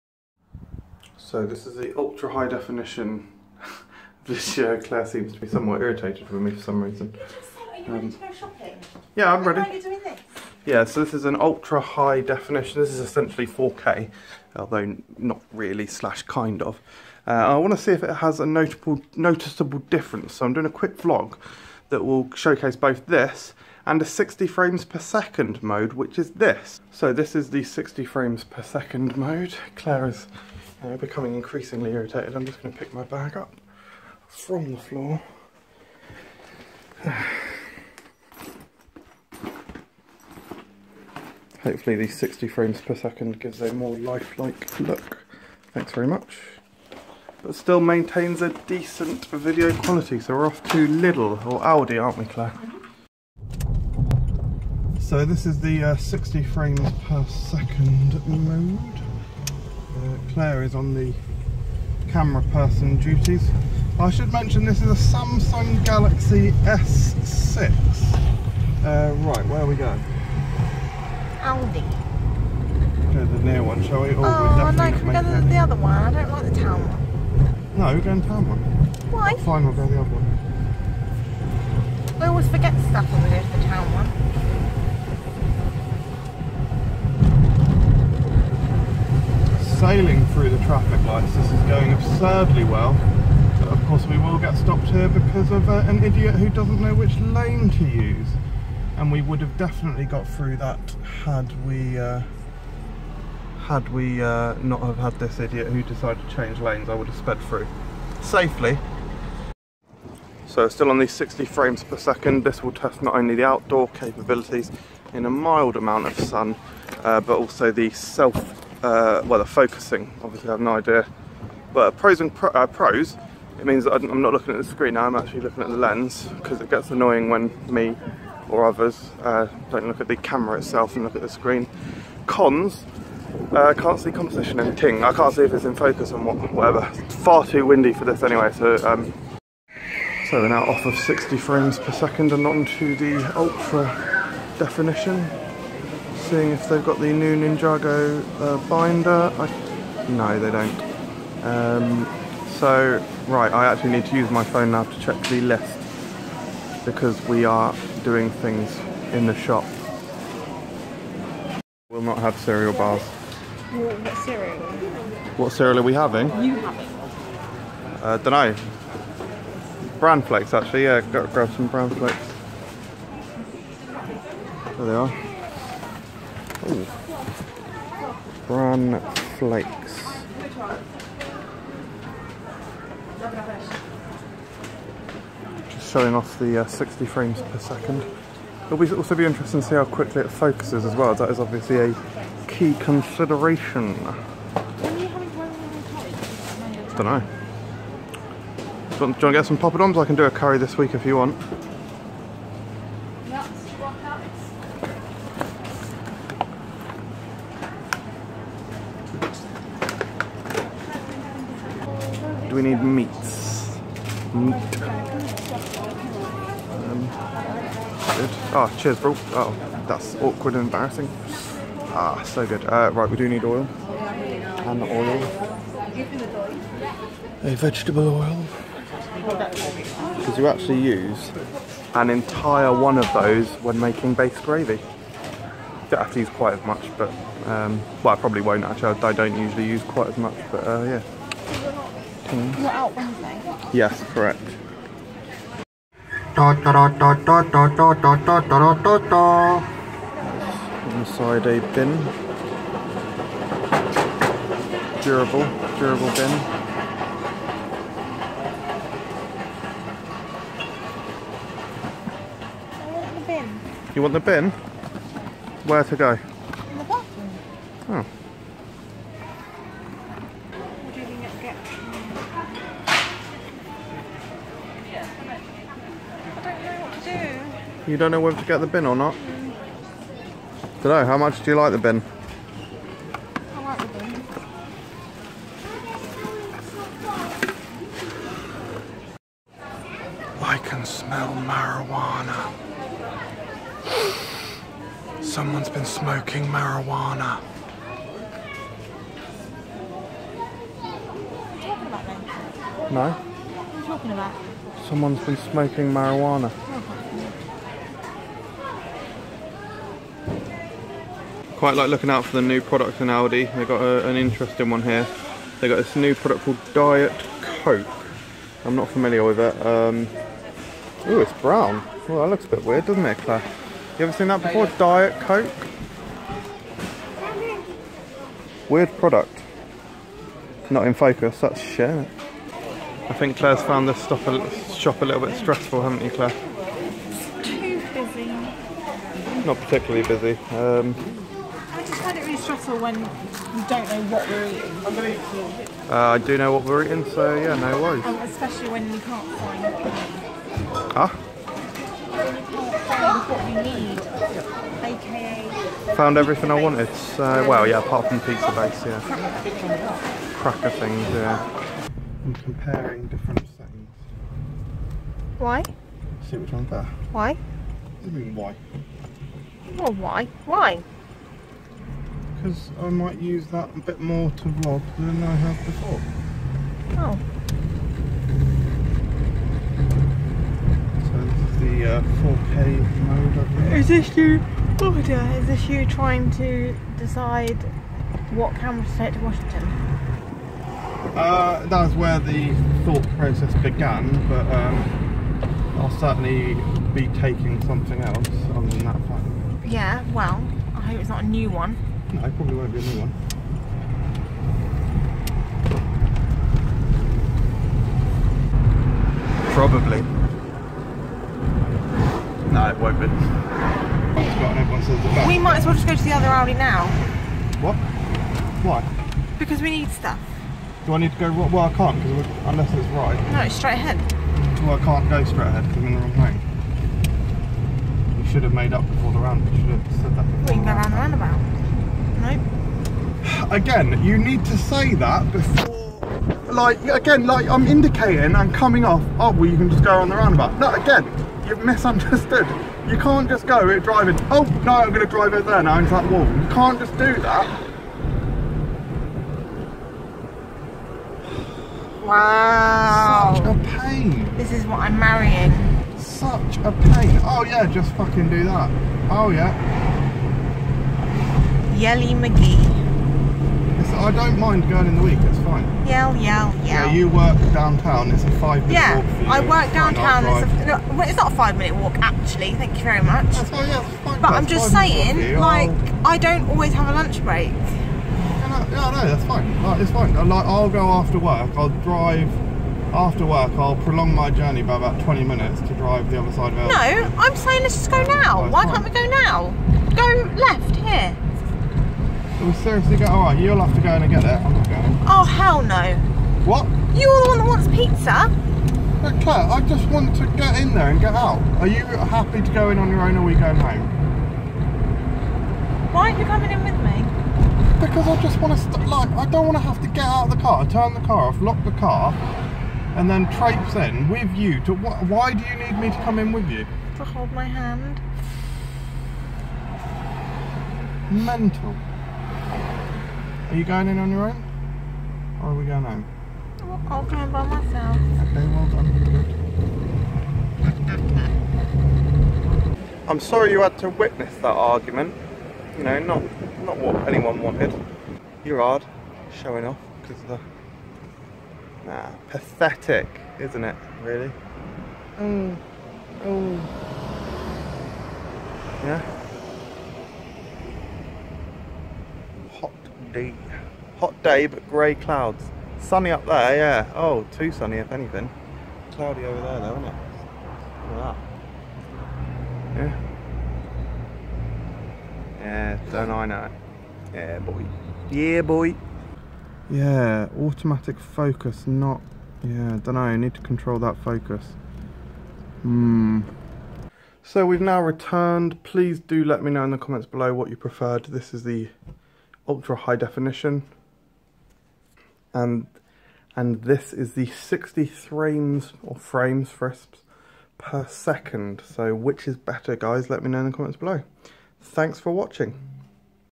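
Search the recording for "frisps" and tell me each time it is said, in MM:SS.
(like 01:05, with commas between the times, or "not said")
09:49.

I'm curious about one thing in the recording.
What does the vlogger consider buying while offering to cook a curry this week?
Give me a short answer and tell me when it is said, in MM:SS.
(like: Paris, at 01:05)
Poppadoms, at 03:19.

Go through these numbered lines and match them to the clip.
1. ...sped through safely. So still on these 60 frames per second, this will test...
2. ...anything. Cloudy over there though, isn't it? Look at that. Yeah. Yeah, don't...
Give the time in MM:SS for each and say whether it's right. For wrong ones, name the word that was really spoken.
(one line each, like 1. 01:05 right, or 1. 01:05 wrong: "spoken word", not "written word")
1. 01:47 right
2. 09:17 right.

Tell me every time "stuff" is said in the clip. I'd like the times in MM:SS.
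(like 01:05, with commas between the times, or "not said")
01:22, 05:34, 06:59.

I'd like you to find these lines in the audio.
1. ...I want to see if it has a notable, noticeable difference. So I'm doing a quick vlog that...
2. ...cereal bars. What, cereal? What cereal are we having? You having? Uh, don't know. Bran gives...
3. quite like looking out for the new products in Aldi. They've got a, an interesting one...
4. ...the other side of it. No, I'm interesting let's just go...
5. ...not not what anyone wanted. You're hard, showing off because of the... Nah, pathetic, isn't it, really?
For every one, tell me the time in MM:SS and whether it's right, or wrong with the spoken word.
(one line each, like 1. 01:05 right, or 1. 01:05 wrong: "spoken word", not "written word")
1. 00:17 right
2. 02:42 wrong: "flakes", not "gives"
3. 05:11 right
4. 08:06 wrong: "saying", not "interesting"
5. 08:55 right.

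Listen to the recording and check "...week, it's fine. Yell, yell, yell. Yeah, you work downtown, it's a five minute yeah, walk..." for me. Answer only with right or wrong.
right.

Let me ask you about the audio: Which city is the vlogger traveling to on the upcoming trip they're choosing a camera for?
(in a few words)
Washington.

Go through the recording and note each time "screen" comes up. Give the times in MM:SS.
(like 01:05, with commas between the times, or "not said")
02:04, 02:11.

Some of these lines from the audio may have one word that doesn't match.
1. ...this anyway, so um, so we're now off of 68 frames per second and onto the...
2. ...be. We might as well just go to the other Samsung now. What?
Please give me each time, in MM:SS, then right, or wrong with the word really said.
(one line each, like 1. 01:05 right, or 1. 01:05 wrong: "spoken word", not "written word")
1. 02:18 wrong: "60", not "68"
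2. 06:52 wrong: "Aldi", not "Samsung".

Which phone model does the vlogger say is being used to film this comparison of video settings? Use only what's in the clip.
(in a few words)
Samsung Galaxy S6.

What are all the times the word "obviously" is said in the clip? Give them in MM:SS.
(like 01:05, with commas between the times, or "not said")
02:00, 03:11.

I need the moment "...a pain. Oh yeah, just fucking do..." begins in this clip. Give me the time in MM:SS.
07:36.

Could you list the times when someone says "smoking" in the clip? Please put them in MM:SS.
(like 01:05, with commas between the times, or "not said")
04:55, 05:05.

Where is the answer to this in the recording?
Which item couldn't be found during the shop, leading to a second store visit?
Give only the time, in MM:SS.
05:58.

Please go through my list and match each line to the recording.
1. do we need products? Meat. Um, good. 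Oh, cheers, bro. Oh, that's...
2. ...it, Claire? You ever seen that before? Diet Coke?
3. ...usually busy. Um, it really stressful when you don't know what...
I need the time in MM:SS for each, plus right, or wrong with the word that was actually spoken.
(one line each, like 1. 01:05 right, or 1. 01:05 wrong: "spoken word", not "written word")
1. 03:32 wrong: "meats", not "products"
2. 05:23 right
3. 05:39 wrong: "particularly", not "usually".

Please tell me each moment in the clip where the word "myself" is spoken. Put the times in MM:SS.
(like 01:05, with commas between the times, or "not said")
08:47.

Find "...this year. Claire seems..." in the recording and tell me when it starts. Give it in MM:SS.
00:04.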